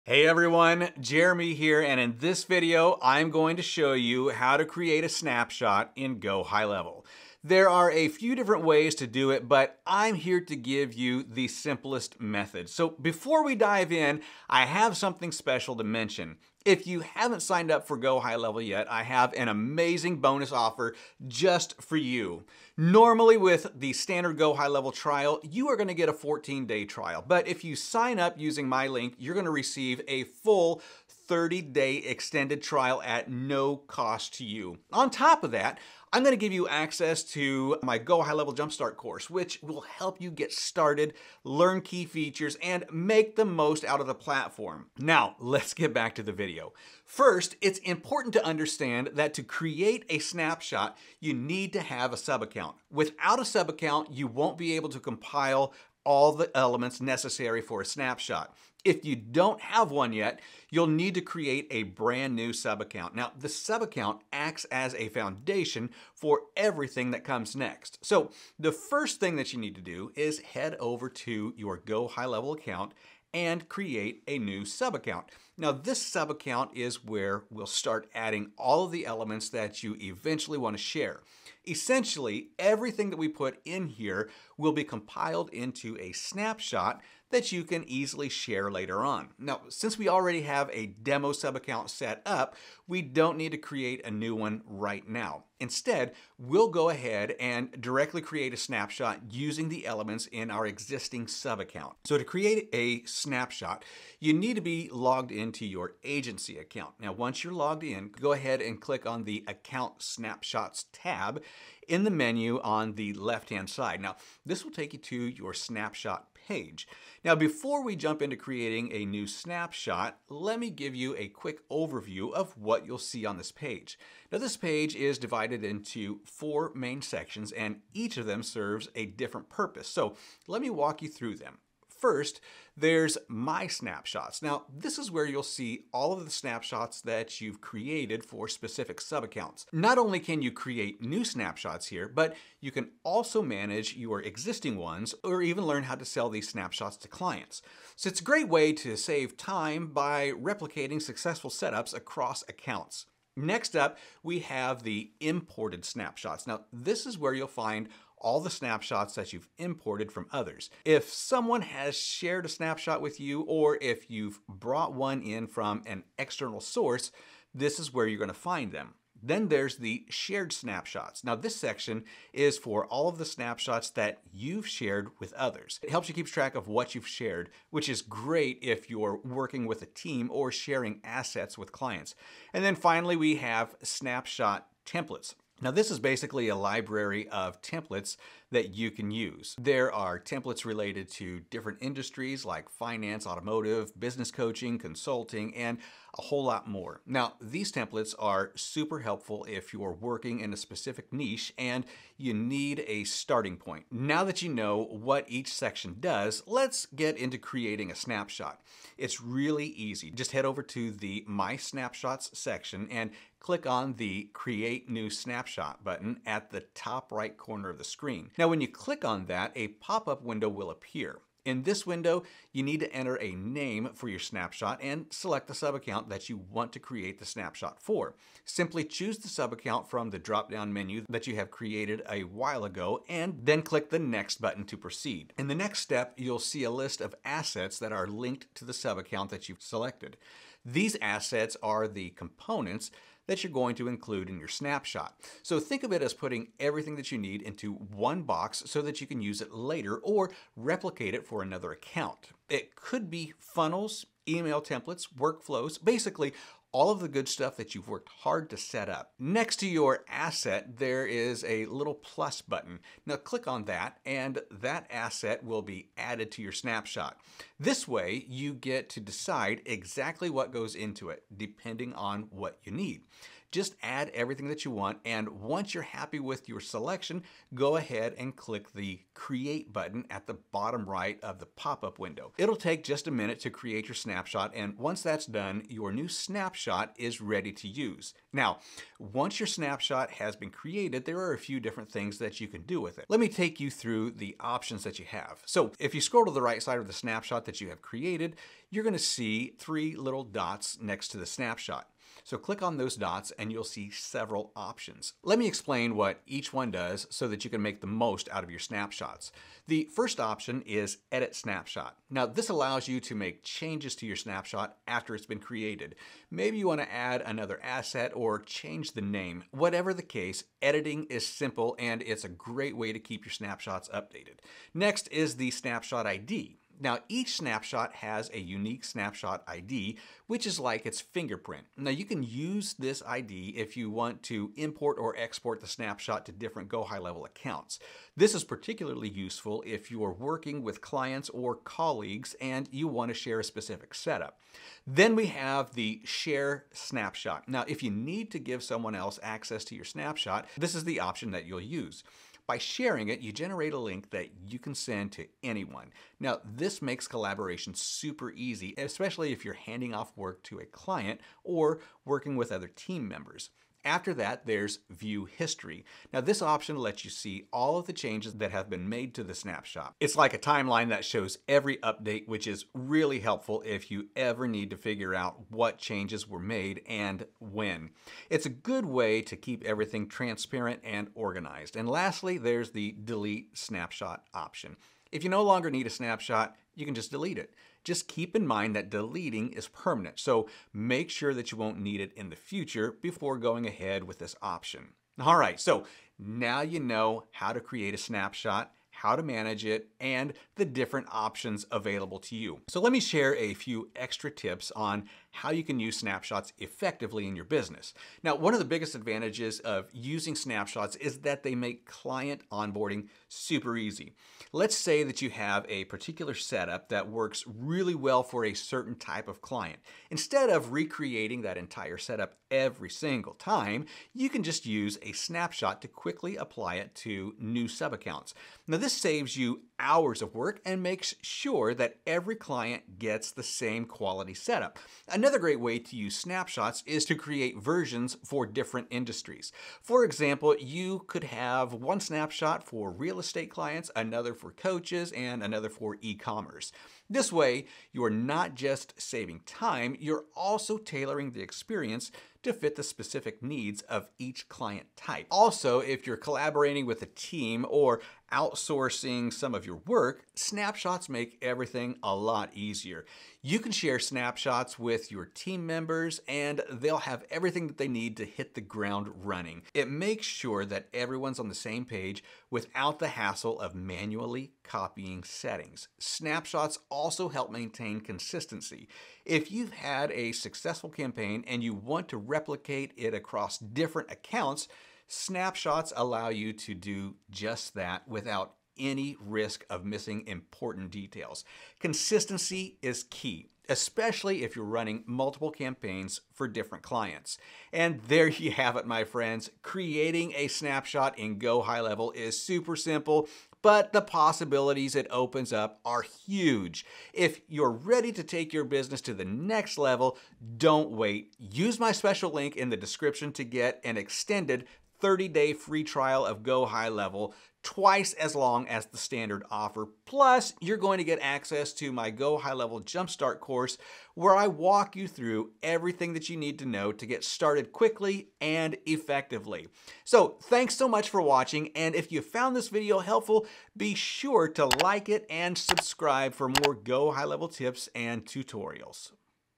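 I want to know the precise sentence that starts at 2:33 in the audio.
Next up, we have the imported snapshots.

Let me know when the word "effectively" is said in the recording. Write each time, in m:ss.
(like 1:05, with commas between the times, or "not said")
6:46, 8:48.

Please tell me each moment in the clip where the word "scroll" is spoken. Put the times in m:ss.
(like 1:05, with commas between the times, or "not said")
4:55.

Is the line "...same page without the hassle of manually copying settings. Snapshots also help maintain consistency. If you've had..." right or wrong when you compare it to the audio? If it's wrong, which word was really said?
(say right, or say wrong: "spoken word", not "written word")
right.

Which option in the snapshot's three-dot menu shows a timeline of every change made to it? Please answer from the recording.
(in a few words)
View History.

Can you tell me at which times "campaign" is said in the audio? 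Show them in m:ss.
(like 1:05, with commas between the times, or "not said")
8:00, 8:15.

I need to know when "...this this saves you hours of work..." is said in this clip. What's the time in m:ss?
7:08.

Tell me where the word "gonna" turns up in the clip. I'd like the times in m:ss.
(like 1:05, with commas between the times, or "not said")
0:36, 2:48, 4:58.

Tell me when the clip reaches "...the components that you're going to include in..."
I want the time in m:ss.
4:01.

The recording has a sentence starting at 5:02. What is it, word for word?
So click on those dots and you'll see several options.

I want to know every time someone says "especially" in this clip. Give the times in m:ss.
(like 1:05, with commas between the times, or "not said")
5:58, 8:13.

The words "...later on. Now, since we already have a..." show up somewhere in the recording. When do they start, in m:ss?
1:28.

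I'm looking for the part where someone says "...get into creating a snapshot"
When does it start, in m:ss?
3:26.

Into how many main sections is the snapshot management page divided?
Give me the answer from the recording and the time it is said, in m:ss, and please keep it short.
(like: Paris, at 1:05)
4, at 2:06.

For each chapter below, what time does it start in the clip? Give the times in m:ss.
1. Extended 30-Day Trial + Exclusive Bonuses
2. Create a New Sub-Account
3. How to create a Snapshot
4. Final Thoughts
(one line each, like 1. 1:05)
1. 0:15
2. 0:46
3. 1:41
4. 8:17.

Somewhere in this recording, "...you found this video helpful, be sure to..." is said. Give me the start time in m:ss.
8:52.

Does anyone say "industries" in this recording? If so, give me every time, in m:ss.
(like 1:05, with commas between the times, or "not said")
3:11, 7:18.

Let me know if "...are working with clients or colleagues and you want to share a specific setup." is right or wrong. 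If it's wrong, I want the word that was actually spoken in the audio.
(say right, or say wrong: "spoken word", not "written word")
right.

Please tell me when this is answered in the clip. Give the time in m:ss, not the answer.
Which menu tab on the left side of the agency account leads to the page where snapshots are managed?
1:49.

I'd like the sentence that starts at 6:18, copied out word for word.
It's a good way to keep everything transparent and organized.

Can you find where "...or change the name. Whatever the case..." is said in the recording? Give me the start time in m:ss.
5:18.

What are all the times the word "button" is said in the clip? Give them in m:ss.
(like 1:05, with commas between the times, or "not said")
3:35, 3:54, 4:22, 4:39.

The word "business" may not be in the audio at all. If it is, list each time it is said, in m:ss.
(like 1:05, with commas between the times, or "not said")
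3:13, 6:47, 8:28.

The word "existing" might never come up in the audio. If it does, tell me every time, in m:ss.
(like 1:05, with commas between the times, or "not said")
1:40, 2:24.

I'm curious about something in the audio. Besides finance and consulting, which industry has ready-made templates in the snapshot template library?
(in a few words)
Automotive.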